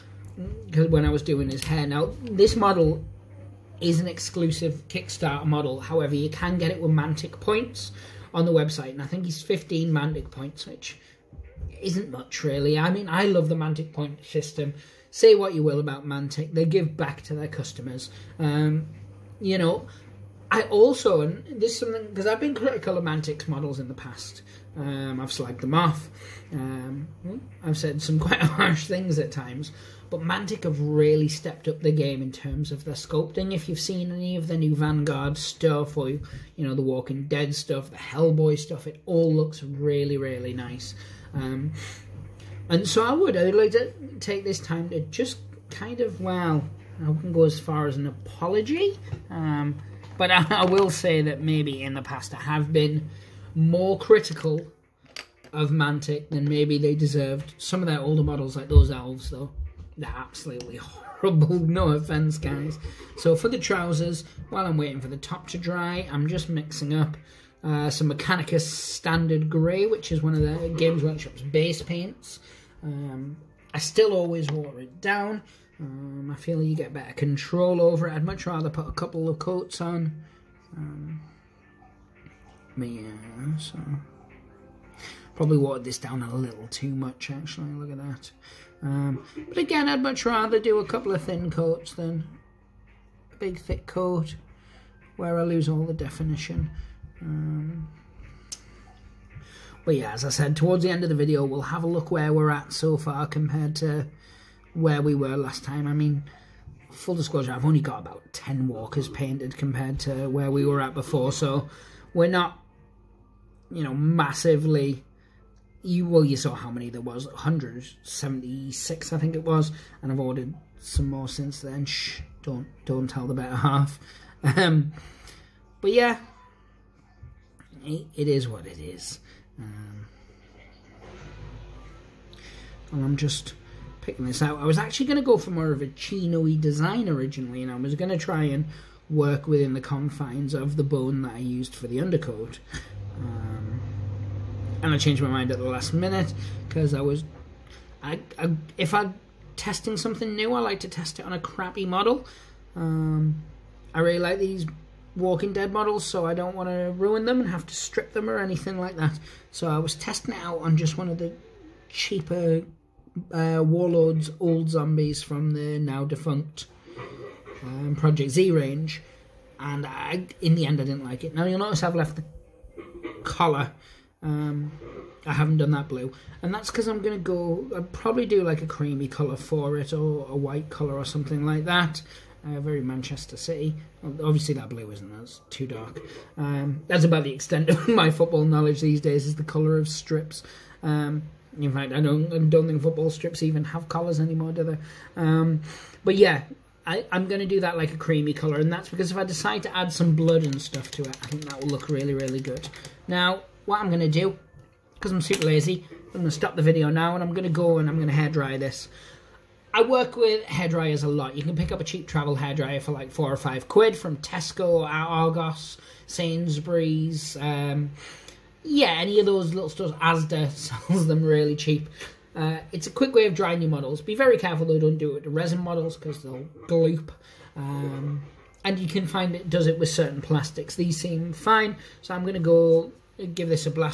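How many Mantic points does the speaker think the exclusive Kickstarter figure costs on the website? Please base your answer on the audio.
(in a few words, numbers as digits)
15.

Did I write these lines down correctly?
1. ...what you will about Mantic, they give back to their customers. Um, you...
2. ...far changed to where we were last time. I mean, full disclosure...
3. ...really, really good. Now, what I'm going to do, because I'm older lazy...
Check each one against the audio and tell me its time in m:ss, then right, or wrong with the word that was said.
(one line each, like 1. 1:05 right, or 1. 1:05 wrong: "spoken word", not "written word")
1. 0:15 right
2. 1:42 wrong: "compared", not "changed"
3. 3:21 wrong: "super", not "older".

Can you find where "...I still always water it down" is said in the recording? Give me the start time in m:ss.
1:13.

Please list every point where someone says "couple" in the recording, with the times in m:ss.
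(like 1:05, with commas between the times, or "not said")
1:18, 1:30.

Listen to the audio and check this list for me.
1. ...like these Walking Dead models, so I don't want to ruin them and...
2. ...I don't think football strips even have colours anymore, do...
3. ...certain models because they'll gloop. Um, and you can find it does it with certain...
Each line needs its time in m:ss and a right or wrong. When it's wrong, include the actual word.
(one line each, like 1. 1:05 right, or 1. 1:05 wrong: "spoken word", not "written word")
1. 2:34 right
2. 3:12 right
3. 3:45 wrong: "resin", not "certain".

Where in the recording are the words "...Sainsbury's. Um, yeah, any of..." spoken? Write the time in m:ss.
3:36.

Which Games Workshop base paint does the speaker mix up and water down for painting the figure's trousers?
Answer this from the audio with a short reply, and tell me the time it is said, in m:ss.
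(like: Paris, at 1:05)
Mechanicus Standard Grey, at 1:08.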